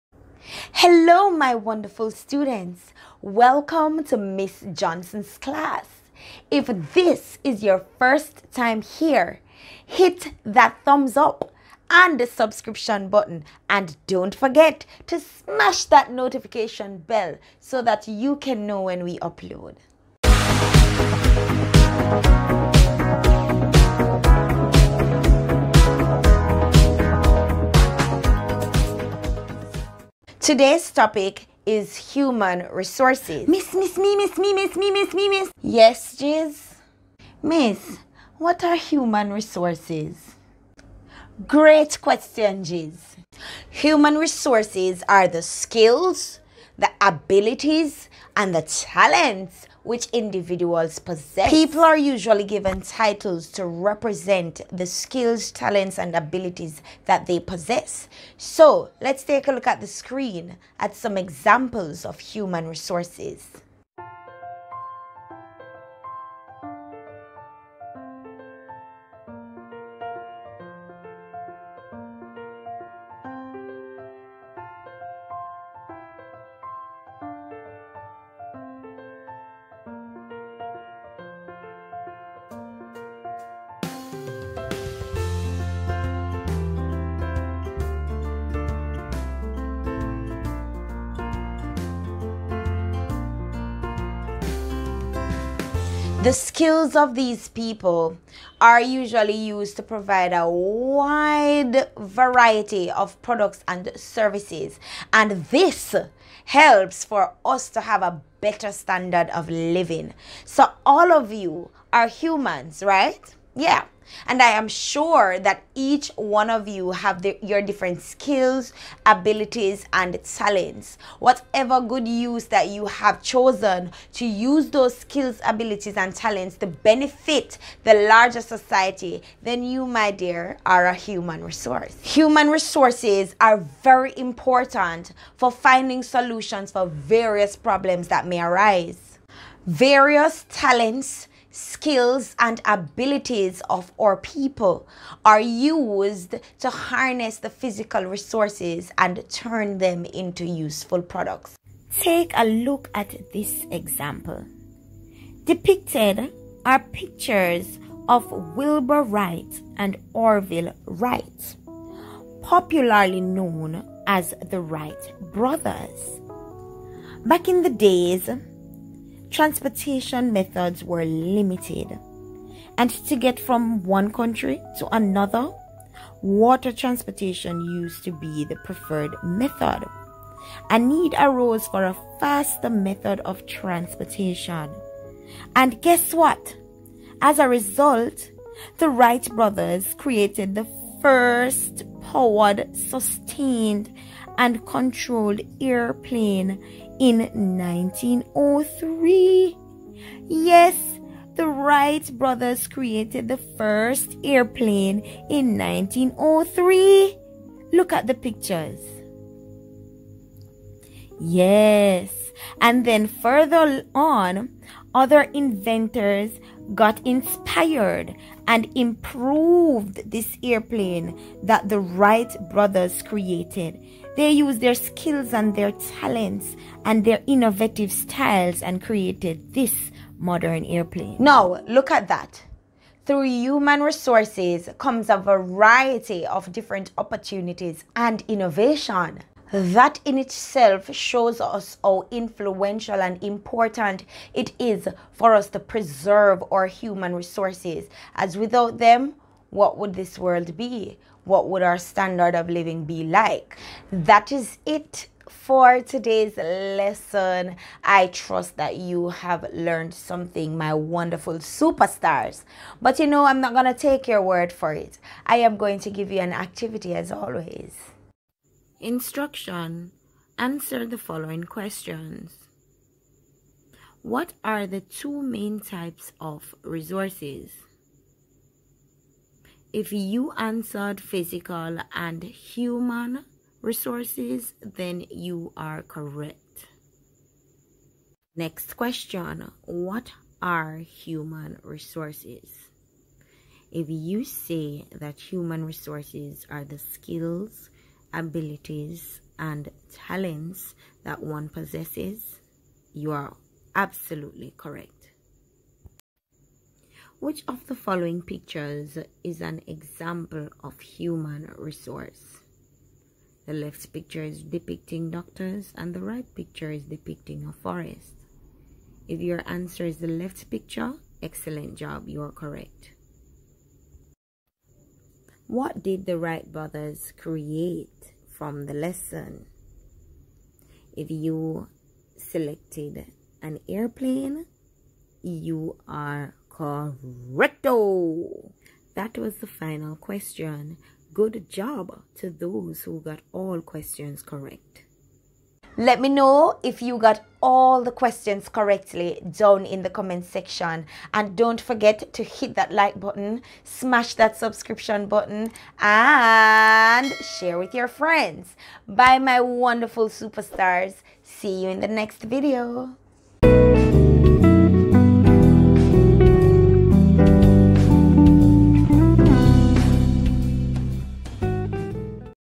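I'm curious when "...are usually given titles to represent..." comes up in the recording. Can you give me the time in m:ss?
0:51.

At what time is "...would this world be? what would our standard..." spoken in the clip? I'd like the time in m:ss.
4:09.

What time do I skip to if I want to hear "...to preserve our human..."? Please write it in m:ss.
4:05.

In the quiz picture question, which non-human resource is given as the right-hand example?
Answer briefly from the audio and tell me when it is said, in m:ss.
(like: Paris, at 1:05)
a forest, at 5:17.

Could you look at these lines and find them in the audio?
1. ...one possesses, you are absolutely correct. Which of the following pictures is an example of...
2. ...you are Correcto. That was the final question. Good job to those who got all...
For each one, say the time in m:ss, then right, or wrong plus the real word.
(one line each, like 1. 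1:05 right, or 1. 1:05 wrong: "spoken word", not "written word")
1. 5:01 right
2. 5:35 right.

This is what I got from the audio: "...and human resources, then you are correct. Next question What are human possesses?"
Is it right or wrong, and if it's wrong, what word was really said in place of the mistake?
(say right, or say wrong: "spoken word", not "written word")
wrong: "resources", not "possesses".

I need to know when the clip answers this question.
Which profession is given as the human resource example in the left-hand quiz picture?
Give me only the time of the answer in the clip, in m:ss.
5:15.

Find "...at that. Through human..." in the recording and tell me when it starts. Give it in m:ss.
3:51.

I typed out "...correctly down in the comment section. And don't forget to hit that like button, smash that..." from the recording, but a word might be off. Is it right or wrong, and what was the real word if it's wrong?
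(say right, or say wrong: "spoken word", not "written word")
right.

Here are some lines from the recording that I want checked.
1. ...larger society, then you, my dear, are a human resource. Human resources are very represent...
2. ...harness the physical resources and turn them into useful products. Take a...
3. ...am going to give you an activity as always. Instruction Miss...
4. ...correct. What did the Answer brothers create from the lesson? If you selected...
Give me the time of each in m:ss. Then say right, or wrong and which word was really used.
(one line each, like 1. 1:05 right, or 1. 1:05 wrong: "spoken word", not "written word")
1. 2:08 wrong: "important", not "represent"
2. 2:26 right
3. 4:25 wrong: "Answer", not "Miss"
4. 5:22 wrong: "Wright", not "Answer".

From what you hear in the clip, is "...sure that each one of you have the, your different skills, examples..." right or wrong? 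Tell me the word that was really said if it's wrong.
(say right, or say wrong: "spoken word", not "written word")
wrong: "abilities", not "examples".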